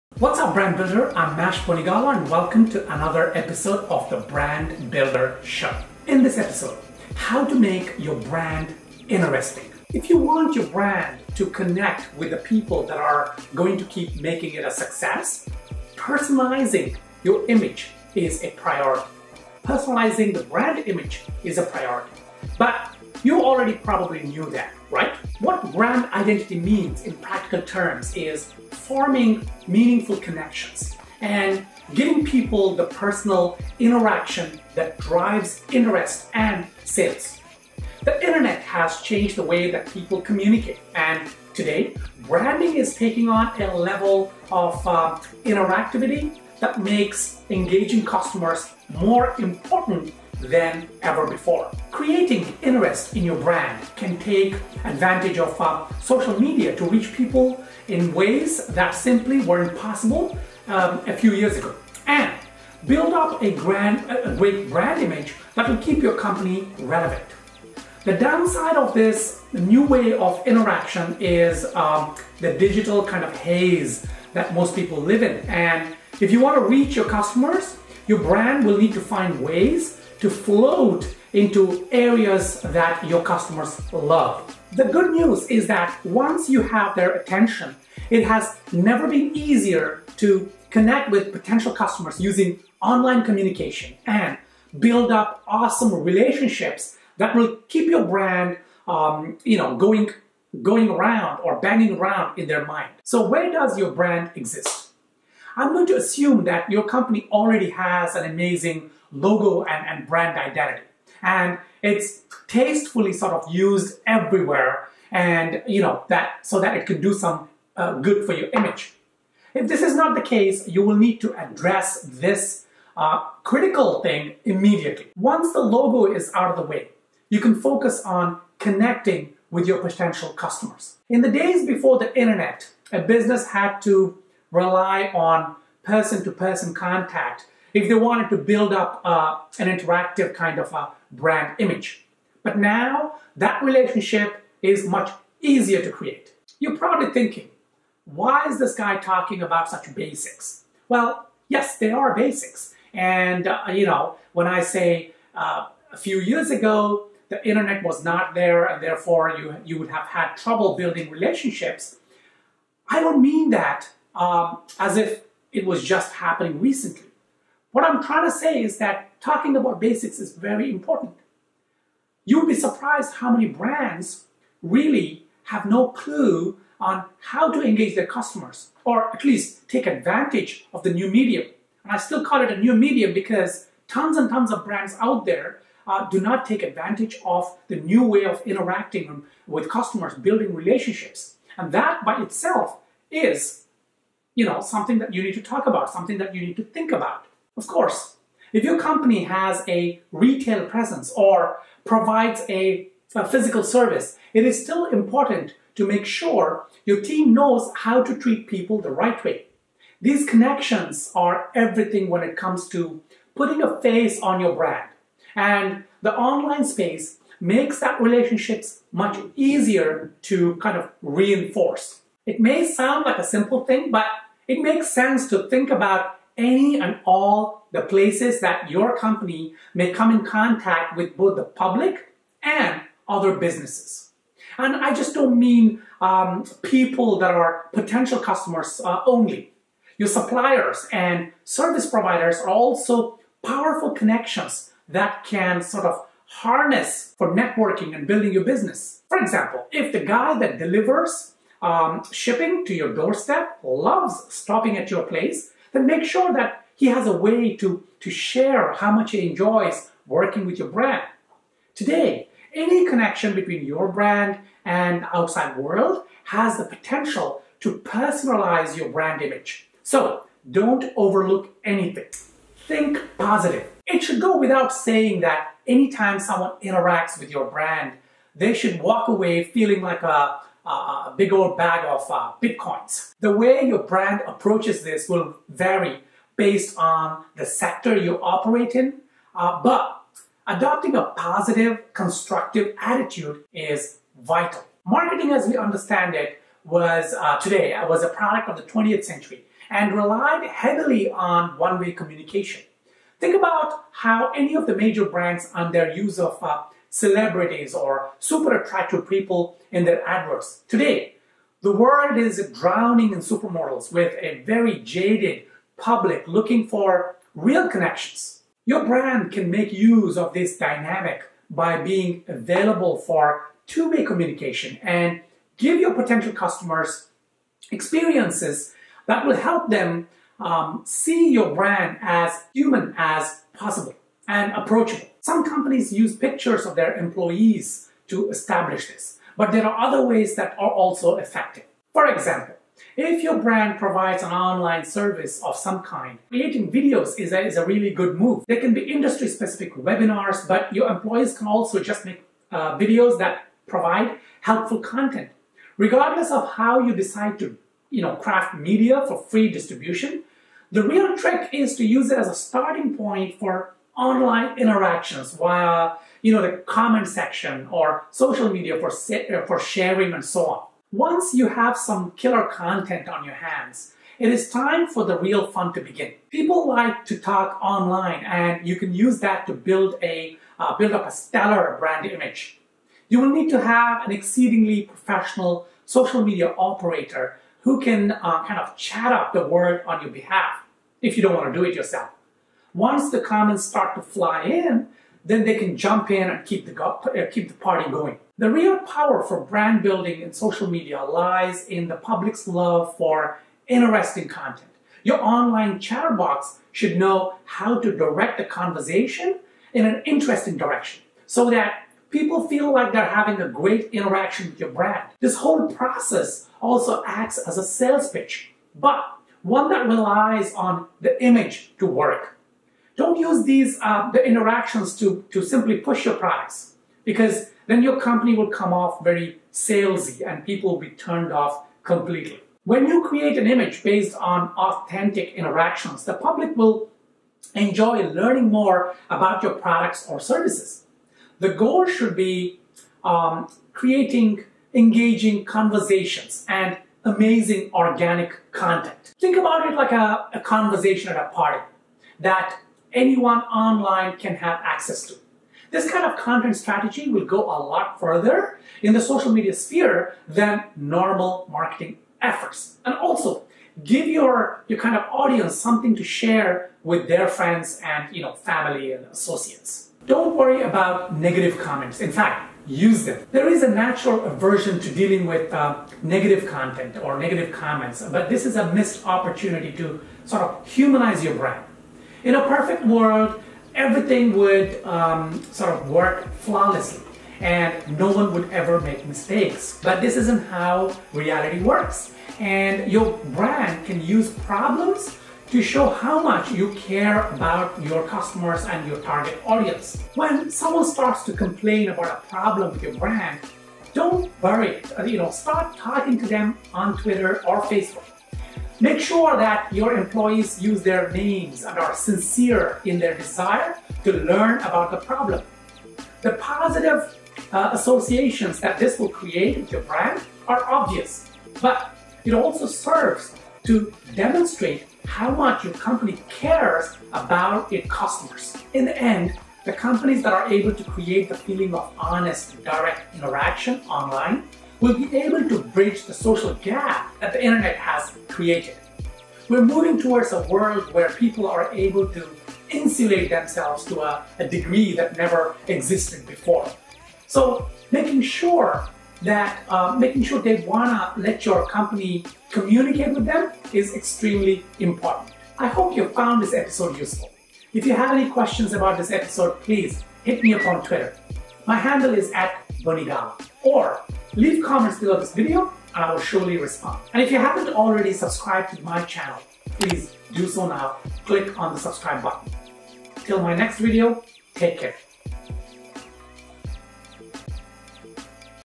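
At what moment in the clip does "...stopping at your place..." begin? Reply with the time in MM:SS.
04:14.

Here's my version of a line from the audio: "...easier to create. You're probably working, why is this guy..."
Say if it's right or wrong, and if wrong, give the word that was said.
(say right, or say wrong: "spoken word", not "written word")
wrong: "thinking", not "working".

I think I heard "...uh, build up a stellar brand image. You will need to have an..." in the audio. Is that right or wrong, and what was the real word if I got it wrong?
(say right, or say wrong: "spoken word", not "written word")
right.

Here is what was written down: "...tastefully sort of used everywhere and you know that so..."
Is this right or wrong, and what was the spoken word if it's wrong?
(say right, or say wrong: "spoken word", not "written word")
right.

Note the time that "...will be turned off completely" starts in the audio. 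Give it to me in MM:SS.
07:10.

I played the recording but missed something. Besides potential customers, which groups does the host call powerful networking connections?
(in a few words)
Suppliers and service providers.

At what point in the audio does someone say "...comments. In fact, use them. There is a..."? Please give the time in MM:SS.
07:51.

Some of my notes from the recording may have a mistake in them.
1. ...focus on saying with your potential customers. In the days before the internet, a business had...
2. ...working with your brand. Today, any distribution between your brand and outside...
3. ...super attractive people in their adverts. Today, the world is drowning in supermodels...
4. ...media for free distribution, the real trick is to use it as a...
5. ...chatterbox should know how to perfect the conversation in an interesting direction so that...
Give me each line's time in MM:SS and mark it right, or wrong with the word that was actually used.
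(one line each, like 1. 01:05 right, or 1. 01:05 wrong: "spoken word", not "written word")
1. 02:07 wrong: "connecting", not "saying"
2. 04:20 wrong: "connection", not "distribution"
3. 05:08 right
4. 05:58 right
5. 06:45 wrong: "direct", not "perfect".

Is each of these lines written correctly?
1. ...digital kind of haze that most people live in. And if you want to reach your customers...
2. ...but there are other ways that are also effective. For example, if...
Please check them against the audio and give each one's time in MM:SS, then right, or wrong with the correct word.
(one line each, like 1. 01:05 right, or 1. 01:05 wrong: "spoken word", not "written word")
1. 01:12 right
2. 05:39 right.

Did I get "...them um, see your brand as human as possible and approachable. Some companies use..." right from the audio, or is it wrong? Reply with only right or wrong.
right.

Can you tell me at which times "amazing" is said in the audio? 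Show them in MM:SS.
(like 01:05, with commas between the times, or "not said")
01:48, 07:27.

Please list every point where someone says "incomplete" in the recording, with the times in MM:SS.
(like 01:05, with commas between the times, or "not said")
not said.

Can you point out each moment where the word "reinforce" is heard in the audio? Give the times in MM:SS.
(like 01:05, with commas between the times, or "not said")
03:41.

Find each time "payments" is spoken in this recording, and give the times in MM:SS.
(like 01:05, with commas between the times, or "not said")
not said.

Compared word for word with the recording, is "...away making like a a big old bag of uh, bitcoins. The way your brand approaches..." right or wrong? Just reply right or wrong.
wrong.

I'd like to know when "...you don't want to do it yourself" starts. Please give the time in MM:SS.
06:31.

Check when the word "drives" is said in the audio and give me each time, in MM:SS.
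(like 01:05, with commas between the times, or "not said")
00:34.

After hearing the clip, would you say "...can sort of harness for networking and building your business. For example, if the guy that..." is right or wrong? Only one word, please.
right.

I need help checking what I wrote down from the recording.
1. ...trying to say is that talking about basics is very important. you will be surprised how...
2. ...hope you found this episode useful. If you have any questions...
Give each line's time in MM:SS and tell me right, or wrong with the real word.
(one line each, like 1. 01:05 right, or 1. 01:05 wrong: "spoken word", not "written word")
1. 02:48 right
2. 09:15 right.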